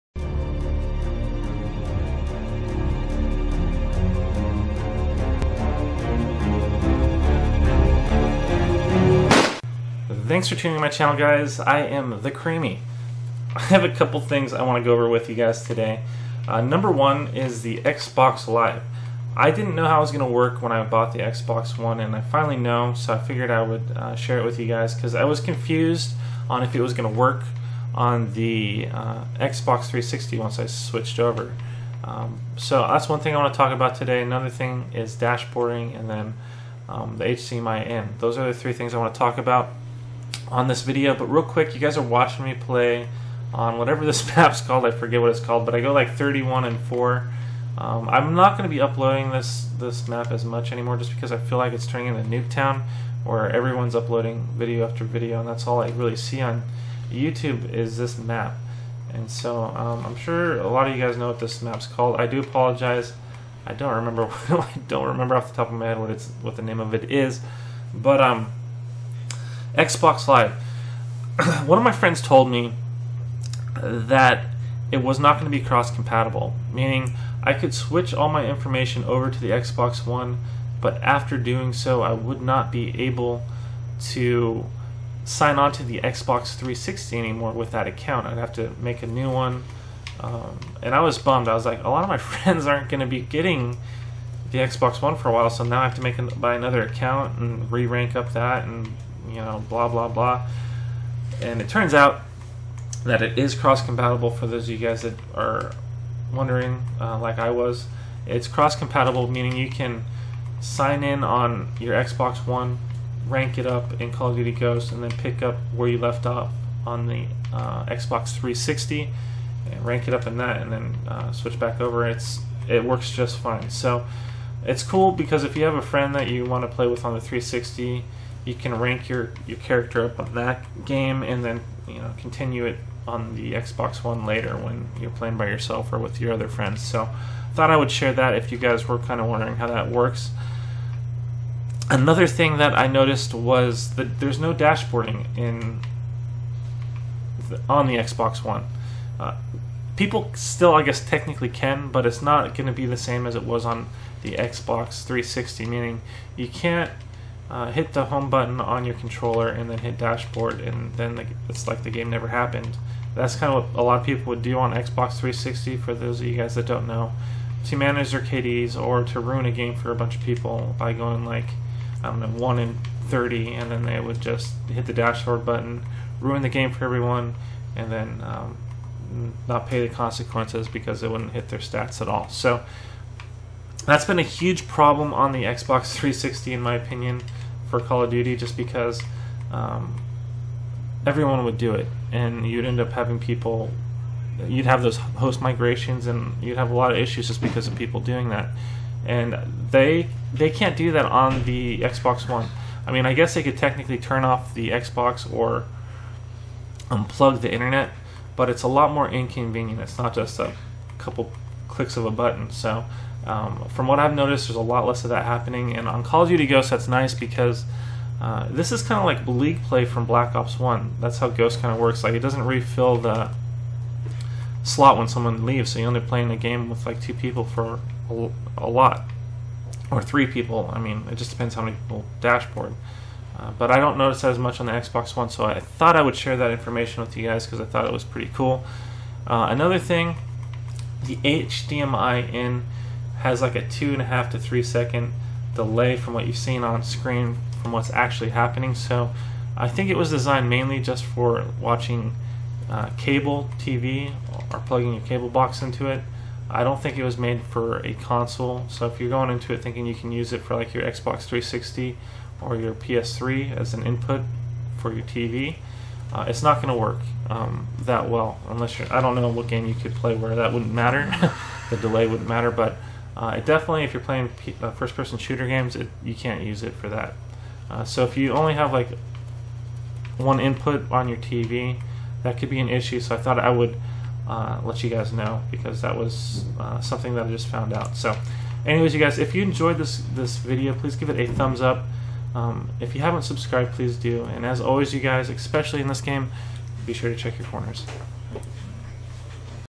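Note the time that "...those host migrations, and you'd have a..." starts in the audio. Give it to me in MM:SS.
03:14.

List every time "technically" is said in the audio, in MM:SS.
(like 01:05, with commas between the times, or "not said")
02:31, 03:23.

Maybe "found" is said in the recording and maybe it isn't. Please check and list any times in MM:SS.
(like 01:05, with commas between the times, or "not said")
04:47.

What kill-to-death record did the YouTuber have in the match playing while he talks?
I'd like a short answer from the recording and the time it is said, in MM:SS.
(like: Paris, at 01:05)
31 and 4, at 00:46.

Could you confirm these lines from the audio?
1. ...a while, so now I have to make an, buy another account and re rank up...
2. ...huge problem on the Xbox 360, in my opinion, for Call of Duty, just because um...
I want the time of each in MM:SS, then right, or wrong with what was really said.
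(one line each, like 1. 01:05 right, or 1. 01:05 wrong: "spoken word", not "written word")
1. 01:35 right
2. 03:04 right.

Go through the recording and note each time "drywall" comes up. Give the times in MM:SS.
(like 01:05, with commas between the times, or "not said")
not said.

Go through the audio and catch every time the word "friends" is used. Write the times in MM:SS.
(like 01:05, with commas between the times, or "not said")
01:11, 01:32, 02:05, 02:16.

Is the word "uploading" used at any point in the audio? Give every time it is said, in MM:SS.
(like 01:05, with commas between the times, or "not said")
00:48, 00:53.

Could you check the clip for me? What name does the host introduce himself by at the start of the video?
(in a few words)
The Creamy.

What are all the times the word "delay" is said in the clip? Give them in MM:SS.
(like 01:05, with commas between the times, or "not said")
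04:05, 04:31.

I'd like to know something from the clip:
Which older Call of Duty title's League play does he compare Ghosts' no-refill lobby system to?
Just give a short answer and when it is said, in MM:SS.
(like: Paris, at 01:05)
Black Ops 1, at 03:40.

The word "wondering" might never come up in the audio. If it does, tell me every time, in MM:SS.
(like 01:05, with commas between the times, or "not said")
01:46, 02:19.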